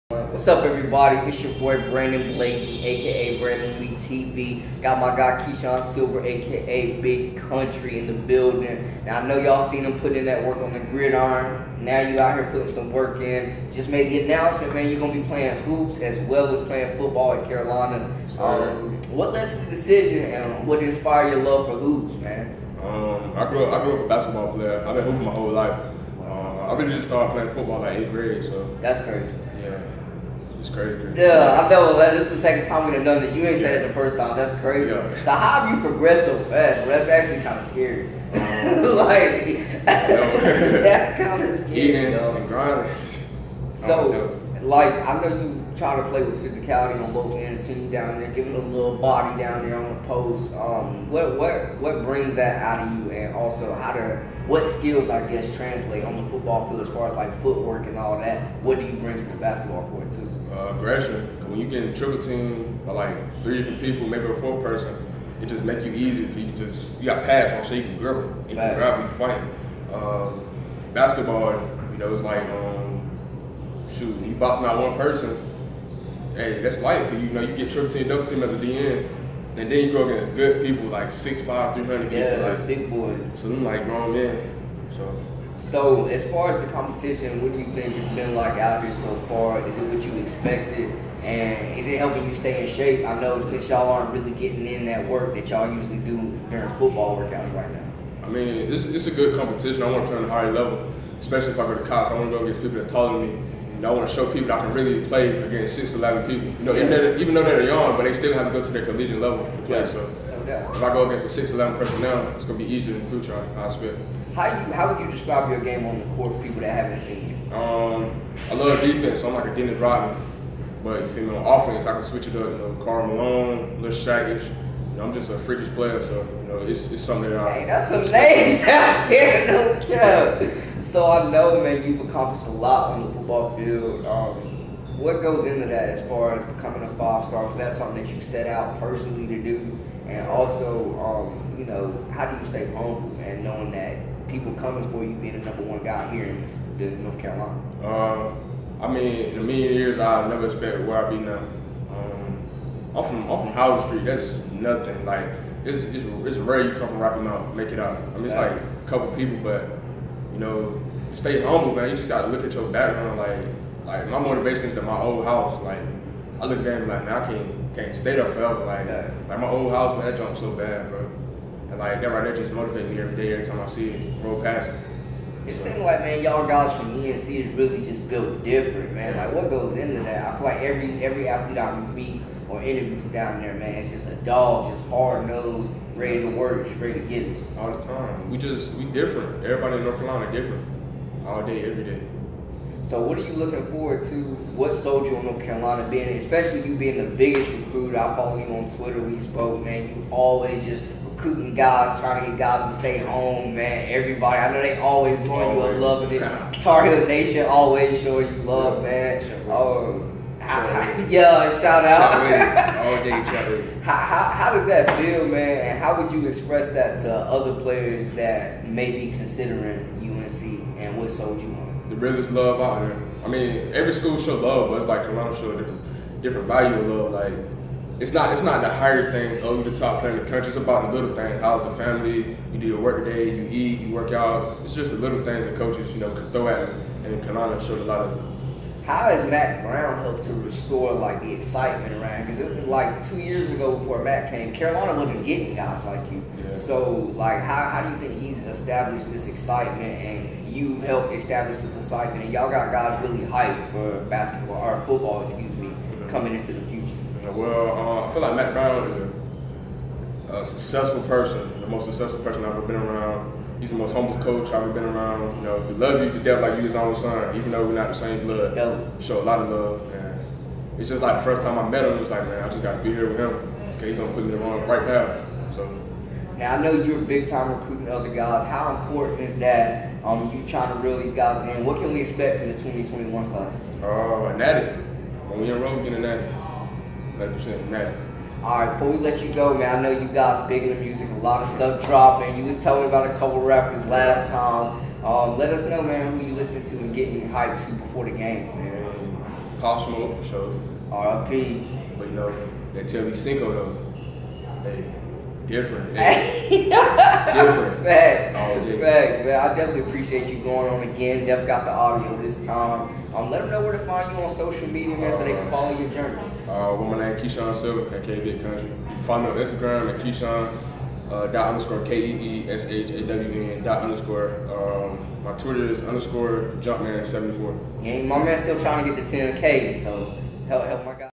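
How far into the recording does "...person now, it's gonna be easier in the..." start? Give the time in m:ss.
1:51.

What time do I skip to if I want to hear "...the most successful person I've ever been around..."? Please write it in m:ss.
4:21.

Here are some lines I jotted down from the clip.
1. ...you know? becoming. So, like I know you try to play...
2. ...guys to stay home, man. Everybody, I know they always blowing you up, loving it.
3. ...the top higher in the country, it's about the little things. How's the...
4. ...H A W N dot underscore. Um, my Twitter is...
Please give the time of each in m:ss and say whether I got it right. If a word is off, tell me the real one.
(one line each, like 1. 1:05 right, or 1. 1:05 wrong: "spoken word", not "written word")
1. 0:42 wrong: "grinding", not "becoming"
2. 3:22 right
3. 3:49 wrong: "player", not "higher"
4. 5:22 right.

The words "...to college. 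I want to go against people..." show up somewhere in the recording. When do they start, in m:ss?
1:41.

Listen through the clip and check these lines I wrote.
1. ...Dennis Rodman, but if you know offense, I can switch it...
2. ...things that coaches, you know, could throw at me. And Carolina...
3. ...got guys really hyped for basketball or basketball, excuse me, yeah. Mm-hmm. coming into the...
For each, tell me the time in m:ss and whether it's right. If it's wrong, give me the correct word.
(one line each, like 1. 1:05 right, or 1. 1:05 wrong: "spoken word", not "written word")
1. 1:59 right
2. 3:55 right
3. 4:12 wrong: "football", not "basketball".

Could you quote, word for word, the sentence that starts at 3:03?
It's just a dog, just hard nosed, ready to work, just ready to get it.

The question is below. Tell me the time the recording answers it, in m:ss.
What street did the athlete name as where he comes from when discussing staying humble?
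2:33.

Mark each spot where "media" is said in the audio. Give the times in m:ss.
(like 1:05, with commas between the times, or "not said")
5:14.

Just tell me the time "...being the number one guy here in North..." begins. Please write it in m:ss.
2:25.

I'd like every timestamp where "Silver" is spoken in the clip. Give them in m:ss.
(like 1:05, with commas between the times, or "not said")
0:05, 5:17.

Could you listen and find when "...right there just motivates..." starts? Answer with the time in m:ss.
2:52.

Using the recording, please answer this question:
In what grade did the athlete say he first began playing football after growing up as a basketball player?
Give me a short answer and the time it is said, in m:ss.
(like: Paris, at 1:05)
8th grade, at 0:27.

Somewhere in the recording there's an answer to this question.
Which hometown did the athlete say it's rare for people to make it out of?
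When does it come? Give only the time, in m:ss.
2:36.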